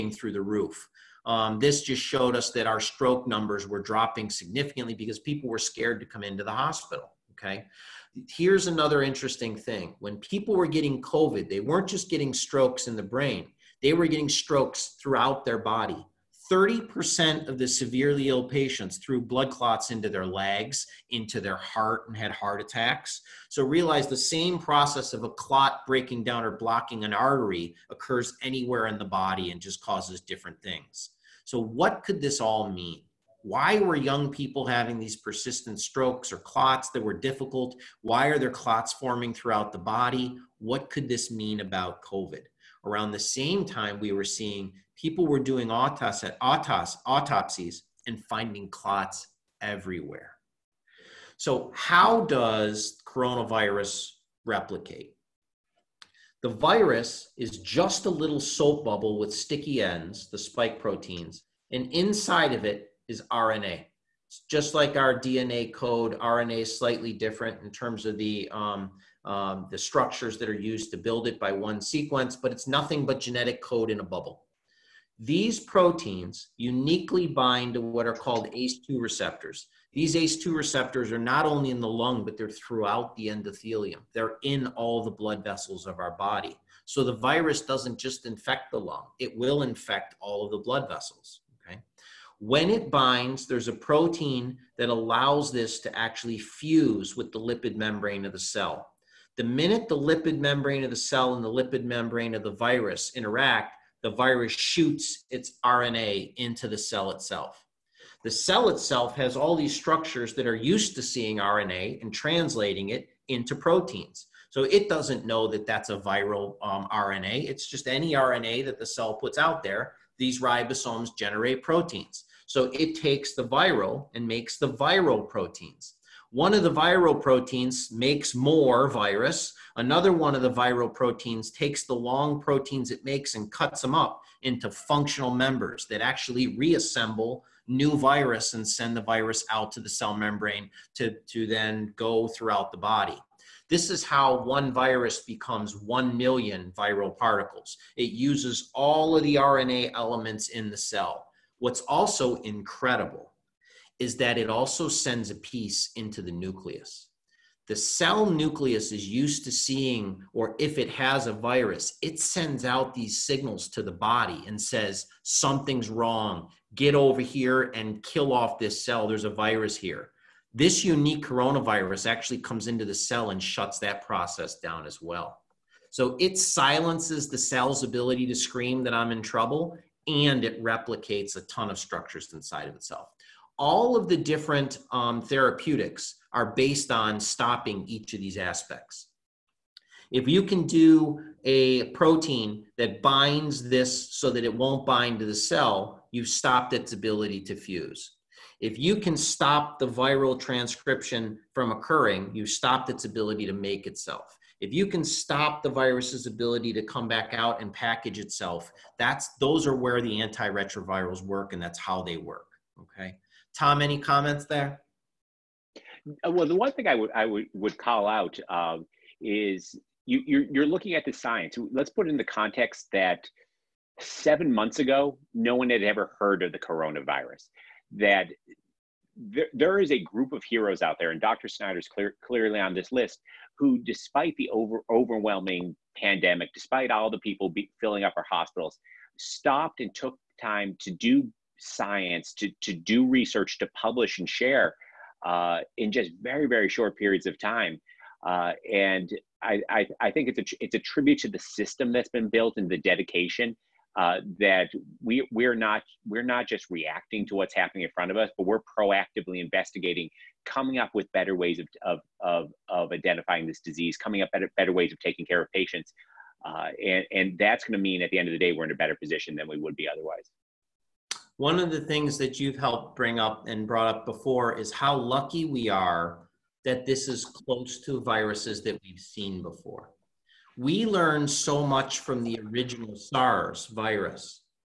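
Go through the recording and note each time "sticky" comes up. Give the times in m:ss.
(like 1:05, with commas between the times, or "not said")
0:59.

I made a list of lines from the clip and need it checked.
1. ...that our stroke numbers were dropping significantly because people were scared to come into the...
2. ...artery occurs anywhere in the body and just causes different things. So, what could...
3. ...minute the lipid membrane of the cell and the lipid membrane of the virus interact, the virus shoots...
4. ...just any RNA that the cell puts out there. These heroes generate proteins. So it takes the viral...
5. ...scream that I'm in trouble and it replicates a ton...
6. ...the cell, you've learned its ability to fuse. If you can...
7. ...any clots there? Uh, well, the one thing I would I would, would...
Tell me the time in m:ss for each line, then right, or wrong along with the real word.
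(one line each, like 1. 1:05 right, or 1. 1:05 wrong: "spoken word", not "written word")
1. 0:02 right
2. 0:27 right
3. 1:39 right
4. 1:57 wrong: "ribosomes", not "heroes"
5. 2:58 right
6. 3:15 wrong: "stopped", not "learned"
7. 3:33 wrong: "comments", not "clots".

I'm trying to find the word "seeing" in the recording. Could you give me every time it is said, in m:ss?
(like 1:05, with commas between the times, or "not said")
0:44, 1:51, 2:39.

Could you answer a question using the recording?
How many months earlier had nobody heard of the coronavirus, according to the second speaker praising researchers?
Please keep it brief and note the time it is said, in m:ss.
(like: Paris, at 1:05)
7, at 3:43.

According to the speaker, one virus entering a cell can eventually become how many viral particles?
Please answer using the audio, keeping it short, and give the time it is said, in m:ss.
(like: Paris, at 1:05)
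1 million, at 2:25.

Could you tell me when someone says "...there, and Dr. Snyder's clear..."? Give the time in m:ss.
3:50.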